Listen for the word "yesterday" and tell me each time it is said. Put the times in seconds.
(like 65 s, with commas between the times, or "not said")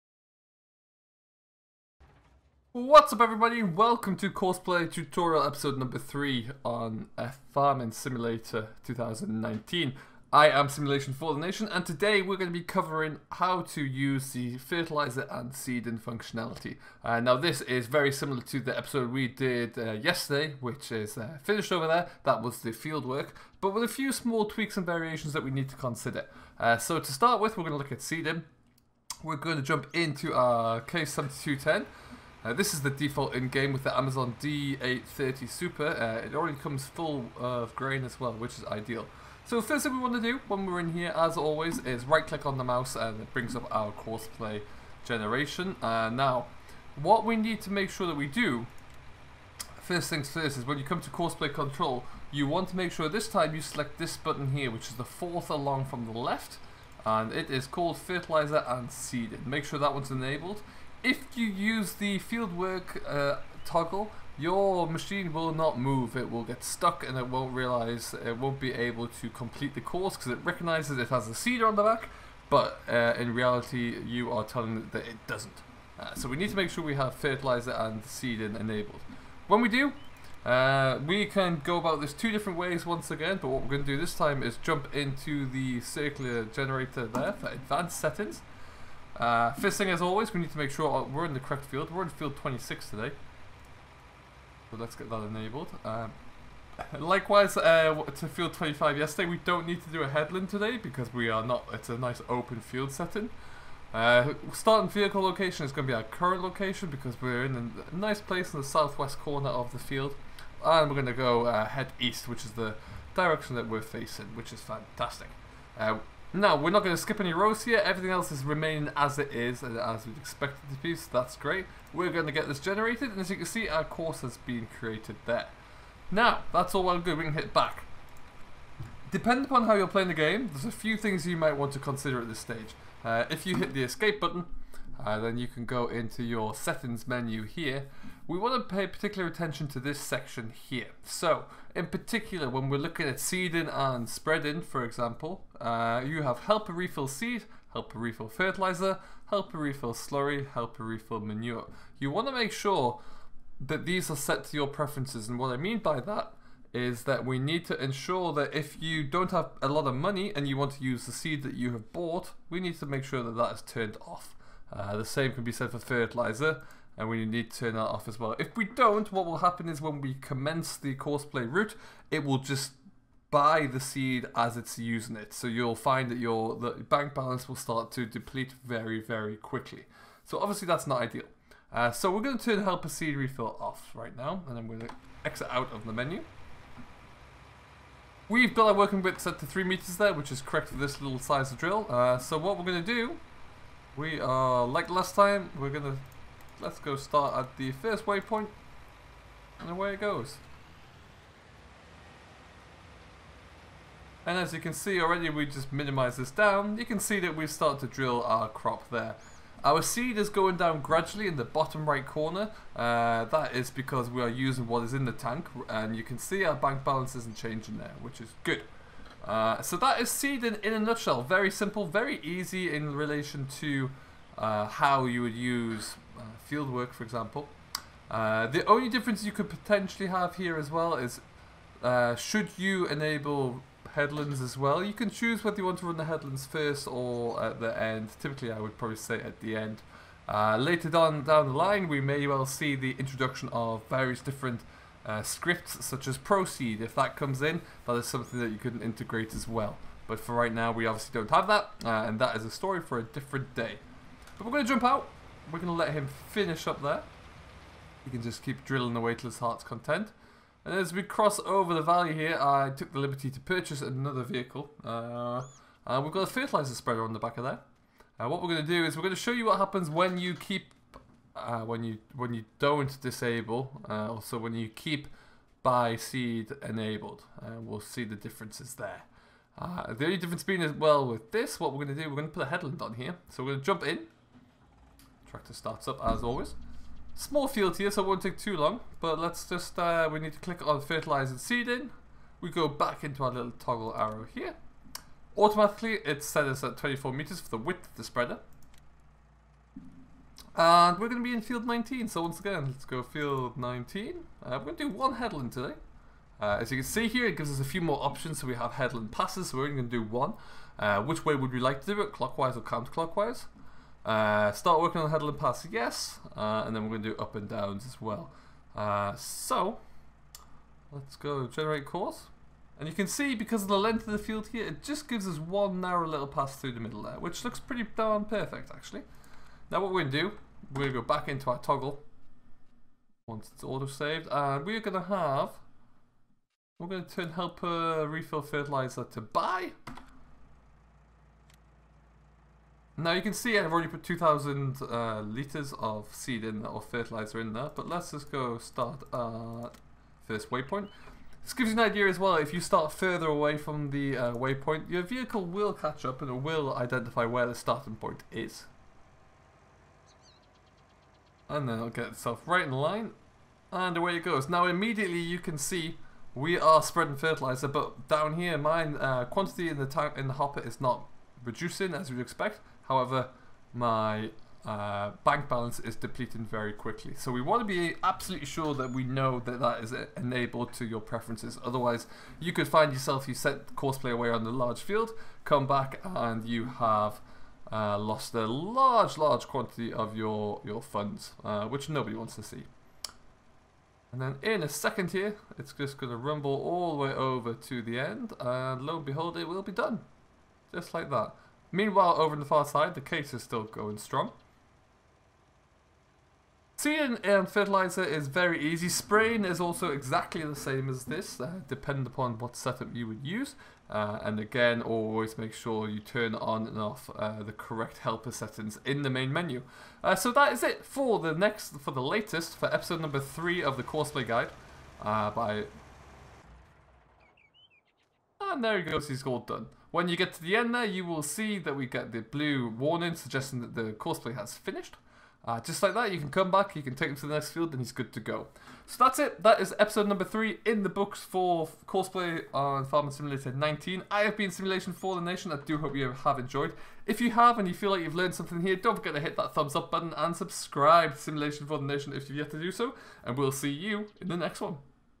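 19 s, 98 s.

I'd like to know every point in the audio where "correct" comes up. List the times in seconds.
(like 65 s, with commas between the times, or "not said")
91 s, 190 s, 417 s.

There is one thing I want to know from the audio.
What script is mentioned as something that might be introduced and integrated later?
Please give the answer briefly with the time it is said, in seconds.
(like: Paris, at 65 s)
ProSeed, at 246 s.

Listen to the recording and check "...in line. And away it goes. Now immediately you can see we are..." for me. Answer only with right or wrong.
right.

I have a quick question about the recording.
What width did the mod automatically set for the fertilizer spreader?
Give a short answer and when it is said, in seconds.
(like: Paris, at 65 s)
24 meters, at 296 s.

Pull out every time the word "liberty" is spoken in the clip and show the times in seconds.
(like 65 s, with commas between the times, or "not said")
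262 s.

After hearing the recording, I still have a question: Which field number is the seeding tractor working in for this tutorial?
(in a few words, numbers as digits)
26.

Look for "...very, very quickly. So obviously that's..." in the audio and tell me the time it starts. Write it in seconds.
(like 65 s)
178 s.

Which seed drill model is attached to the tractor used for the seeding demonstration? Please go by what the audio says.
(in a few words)
Amazone D830 Super.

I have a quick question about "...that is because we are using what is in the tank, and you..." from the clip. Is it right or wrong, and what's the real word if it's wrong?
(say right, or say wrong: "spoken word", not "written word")
right.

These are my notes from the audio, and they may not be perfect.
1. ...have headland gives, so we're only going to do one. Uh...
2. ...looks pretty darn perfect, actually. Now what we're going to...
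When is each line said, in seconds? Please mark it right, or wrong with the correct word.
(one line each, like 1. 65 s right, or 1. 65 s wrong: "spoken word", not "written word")
1. 308 s wrong: "passes", not "gives"
2. 327 s right.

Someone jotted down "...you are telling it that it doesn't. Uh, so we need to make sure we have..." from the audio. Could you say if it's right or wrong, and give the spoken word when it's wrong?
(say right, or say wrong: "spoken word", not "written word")
right.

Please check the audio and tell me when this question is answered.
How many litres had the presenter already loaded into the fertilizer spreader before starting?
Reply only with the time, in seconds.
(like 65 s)
344 s.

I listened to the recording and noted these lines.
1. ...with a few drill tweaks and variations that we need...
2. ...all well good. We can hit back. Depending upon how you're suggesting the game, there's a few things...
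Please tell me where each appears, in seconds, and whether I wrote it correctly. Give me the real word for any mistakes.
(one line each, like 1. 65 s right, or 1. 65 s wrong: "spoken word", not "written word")
1. 23 s wrong: "small", not "drill"
2. 126 s wrong: "playing", not "suggesting".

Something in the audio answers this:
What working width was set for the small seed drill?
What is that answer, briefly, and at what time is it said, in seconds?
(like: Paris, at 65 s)
3 meters, at 189 s.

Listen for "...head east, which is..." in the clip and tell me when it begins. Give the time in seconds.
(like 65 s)
111 s.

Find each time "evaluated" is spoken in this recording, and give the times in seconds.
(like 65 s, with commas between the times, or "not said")
not said.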